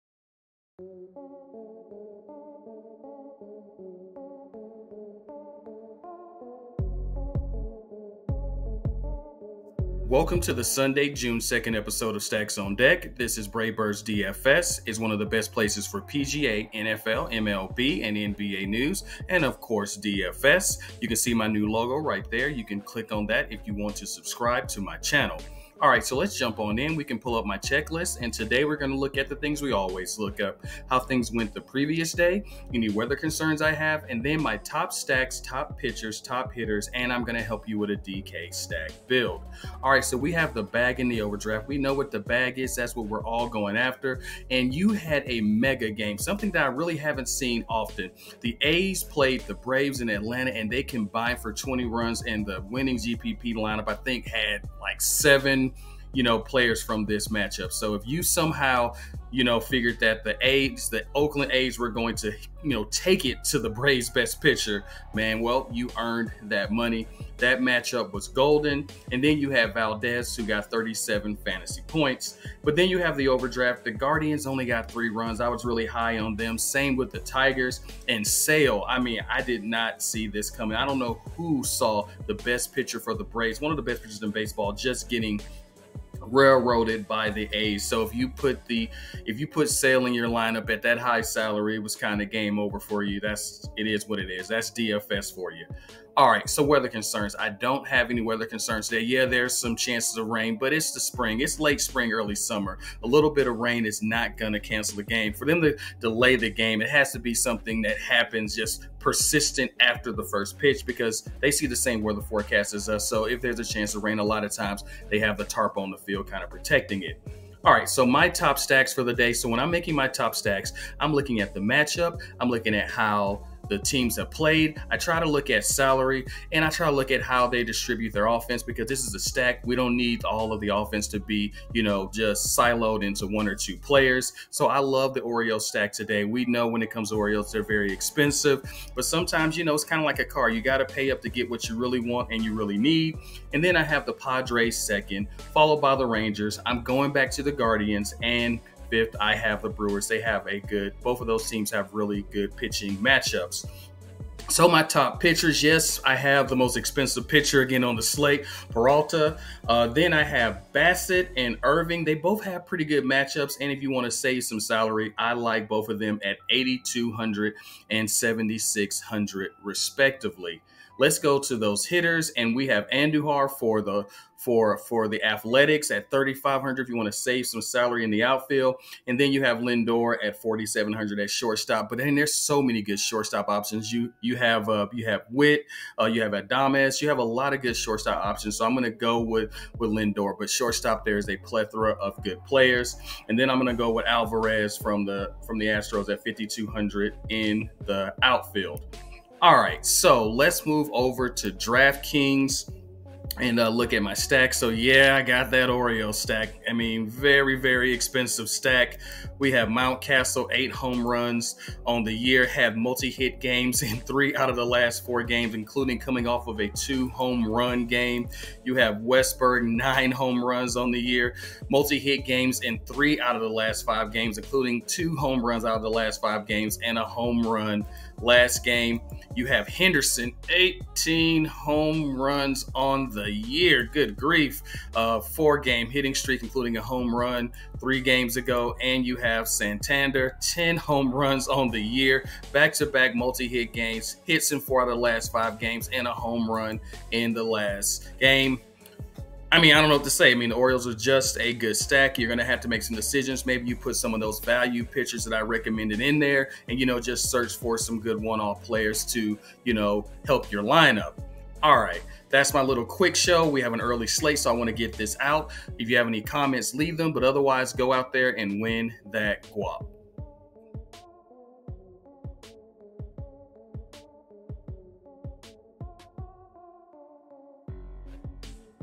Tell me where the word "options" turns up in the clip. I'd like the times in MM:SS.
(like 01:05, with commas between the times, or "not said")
03:03, 03:08.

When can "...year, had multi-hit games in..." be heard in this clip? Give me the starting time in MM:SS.
03:32.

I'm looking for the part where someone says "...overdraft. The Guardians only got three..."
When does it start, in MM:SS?
01:13.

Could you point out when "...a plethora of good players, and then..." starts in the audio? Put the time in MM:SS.
03:11.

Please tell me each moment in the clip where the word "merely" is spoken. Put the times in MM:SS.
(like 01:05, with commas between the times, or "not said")
not said.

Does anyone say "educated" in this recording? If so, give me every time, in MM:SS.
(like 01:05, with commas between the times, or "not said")
not said.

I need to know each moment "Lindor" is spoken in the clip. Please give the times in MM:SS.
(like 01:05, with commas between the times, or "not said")
02:59, 03:09.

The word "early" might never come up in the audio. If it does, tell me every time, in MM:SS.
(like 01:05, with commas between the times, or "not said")
01:42, 04:23.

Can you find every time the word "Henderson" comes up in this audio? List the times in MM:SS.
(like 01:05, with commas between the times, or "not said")
03:49.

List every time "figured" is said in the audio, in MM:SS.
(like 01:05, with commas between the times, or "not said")
00:59.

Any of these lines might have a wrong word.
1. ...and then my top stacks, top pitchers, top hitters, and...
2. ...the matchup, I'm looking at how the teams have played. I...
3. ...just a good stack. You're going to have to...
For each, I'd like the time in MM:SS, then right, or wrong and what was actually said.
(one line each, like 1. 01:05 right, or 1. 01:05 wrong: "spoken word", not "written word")
1. 00:34 right
2. 02:01 right
3. 04:10 right.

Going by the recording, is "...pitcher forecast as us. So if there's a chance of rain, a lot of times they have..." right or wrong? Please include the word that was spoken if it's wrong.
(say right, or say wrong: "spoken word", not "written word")
wrong: "weather", not "pitcher".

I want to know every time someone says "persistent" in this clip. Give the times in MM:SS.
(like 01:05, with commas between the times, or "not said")
01:48.